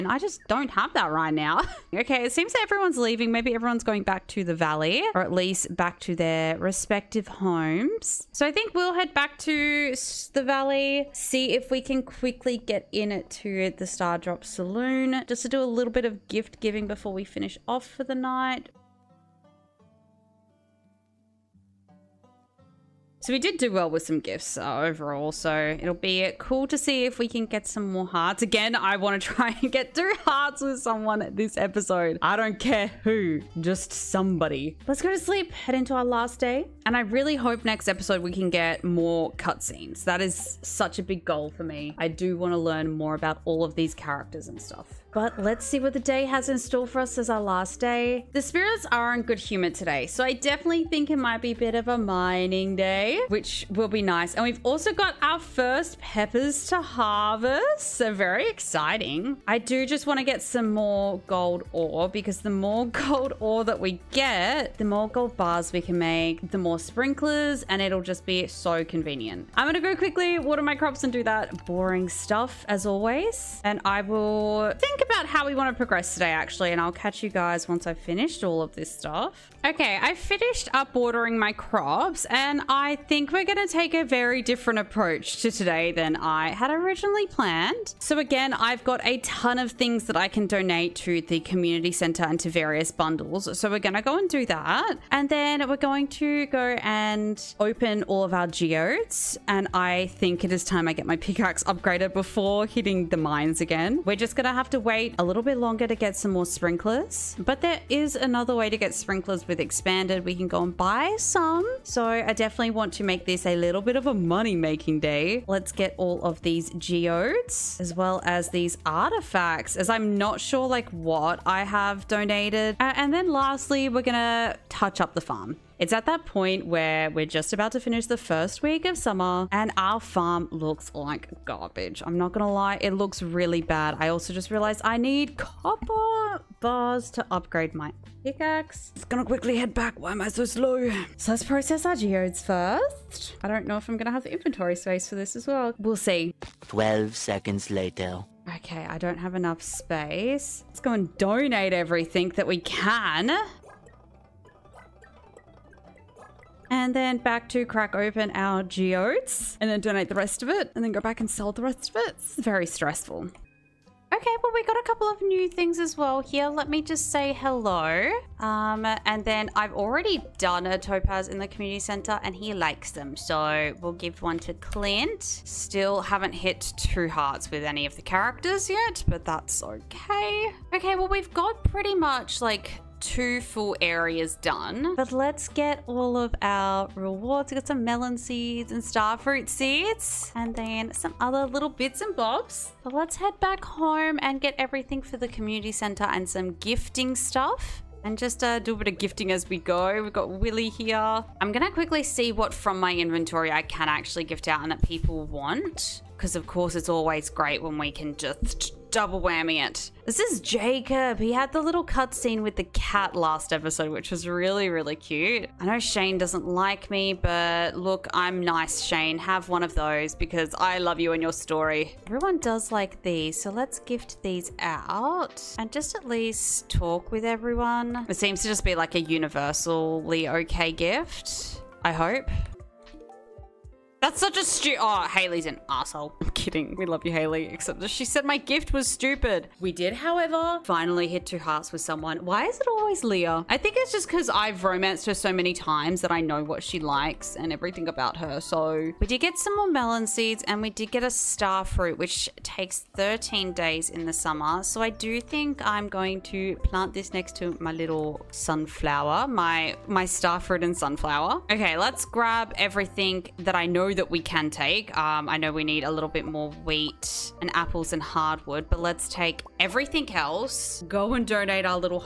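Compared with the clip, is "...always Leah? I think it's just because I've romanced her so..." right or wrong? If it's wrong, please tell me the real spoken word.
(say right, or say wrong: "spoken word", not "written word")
right.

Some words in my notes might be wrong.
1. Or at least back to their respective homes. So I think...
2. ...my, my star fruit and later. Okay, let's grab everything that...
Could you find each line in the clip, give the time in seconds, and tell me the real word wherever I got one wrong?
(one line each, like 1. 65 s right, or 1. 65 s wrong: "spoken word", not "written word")
1. 5 s right
2. 259 s wrong: "sunflower", not "later".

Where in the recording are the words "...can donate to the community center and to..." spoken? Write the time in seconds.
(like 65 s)
90 s.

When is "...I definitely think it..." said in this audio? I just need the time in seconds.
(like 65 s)
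50 s.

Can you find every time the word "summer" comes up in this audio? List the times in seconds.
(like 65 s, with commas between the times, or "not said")
128 s, 254 s.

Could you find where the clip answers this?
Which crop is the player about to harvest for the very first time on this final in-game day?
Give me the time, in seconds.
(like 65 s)
56 s.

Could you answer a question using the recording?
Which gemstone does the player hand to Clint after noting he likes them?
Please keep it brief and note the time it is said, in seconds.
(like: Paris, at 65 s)
Topaz, at 170 s.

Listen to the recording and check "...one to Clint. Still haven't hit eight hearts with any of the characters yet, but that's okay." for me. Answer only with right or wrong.
wrong.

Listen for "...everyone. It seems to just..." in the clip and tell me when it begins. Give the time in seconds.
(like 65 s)
227 s.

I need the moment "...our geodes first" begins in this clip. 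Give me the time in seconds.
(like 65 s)
141 s.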